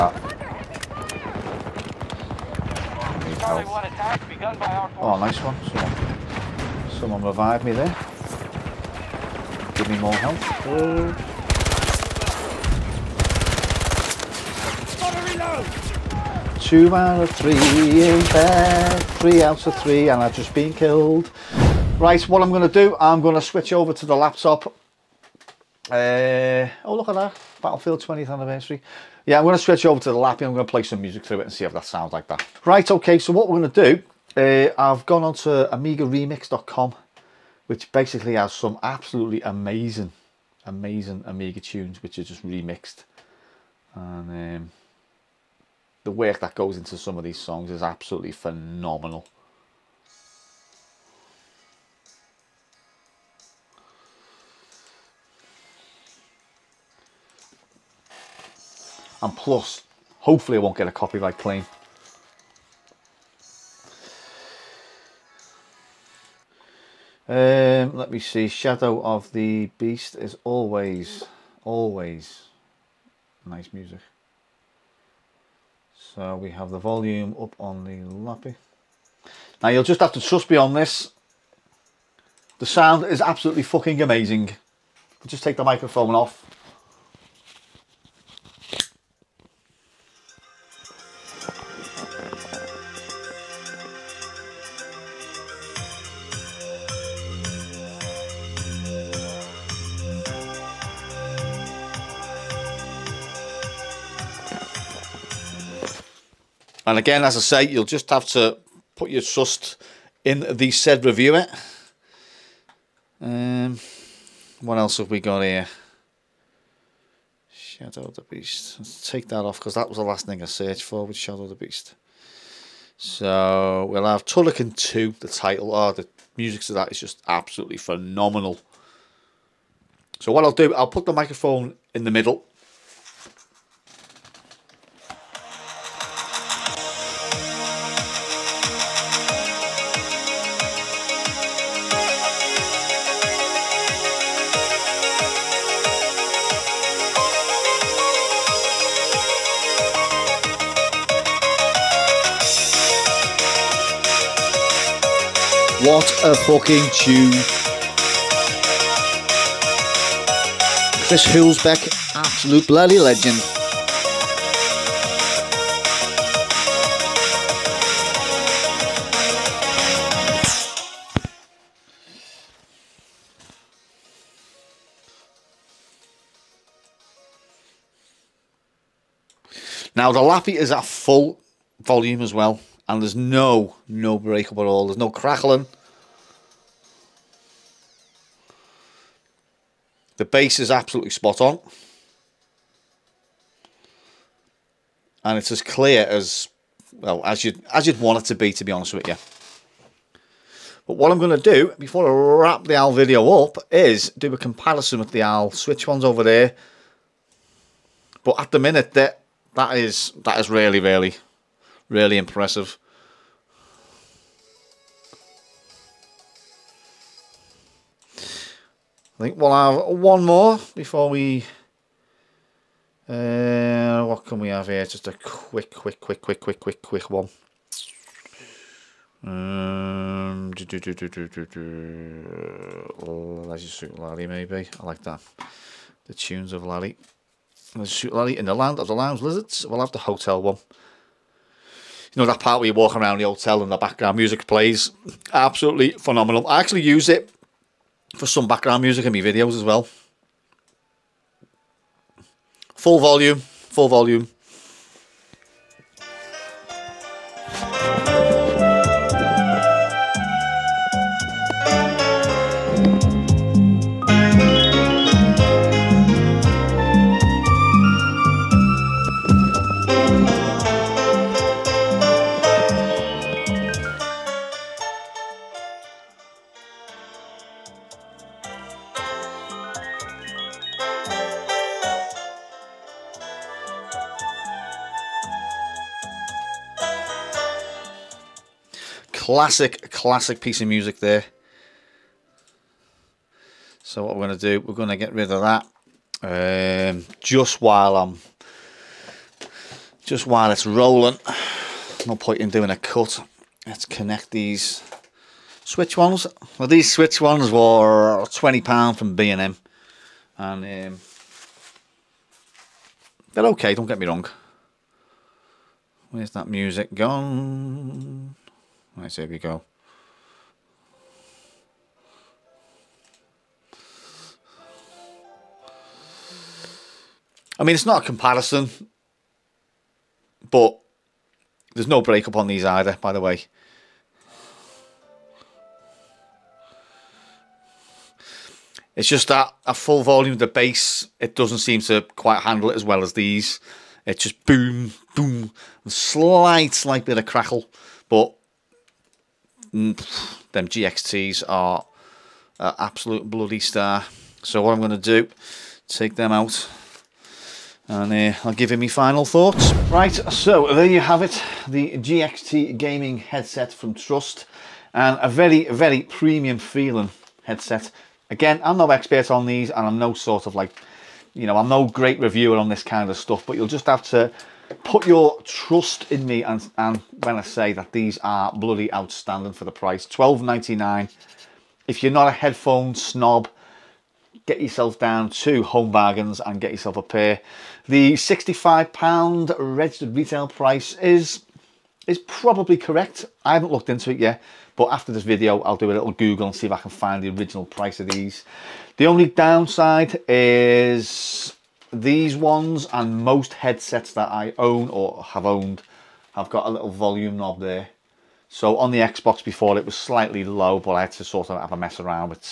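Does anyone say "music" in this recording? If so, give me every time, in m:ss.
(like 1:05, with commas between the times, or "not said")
0:31, 1:13, 2:06, 4:04, 4:08, 4:50, 5:16.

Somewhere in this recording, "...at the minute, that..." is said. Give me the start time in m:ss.
3:28.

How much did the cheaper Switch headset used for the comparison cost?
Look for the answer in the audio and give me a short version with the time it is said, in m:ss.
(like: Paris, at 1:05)
£20, at 5:08.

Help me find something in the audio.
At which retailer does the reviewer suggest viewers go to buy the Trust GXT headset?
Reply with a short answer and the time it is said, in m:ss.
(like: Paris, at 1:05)
Home Bargains, at 6:25.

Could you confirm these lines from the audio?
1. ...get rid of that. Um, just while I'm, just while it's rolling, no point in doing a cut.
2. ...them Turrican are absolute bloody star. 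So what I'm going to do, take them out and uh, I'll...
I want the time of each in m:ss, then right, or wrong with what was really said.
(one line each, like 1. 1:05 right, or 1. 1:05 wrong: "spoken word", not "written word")
1. 4:54 right
2. 5:49 wrong: "GXTs", not "Turrican".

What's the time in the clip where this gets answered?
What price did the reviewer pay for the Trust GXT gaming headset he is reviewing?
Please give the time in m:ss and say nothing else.
6:20.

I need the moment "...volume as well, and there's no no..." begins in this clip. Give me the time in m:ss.
3:01.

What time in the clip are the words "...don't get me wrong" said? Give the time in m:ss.
5:13.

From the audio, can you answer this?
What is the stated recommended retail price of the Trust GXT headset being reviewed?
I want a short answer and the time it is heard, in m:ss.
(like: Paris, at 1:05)
£65, at 6:28.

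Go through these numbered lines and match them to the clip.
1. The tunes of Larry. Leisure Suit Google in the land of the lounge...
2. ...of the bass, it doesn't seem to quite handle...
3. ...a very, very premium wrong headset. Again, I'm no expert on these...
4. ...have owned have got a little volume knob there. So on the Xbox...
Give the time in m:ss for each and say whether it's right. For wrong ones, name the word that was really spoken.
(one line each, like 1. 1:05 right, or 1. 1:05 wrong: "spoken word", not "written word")
1. 3:56 wrong: "Larry", not "Google"
2. 5:40 right
3. 6:05 wrong: "feeling", not "wrong"
4. 6:45 right.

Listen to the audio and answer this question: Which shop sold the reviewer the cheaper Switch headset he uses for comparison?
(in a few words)
B&M.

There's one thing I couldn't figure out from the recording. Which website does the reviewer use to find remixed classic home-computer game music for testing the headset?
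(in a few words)
AmigaRemix.com.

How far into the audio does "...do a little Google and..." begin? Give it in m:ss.
6:35.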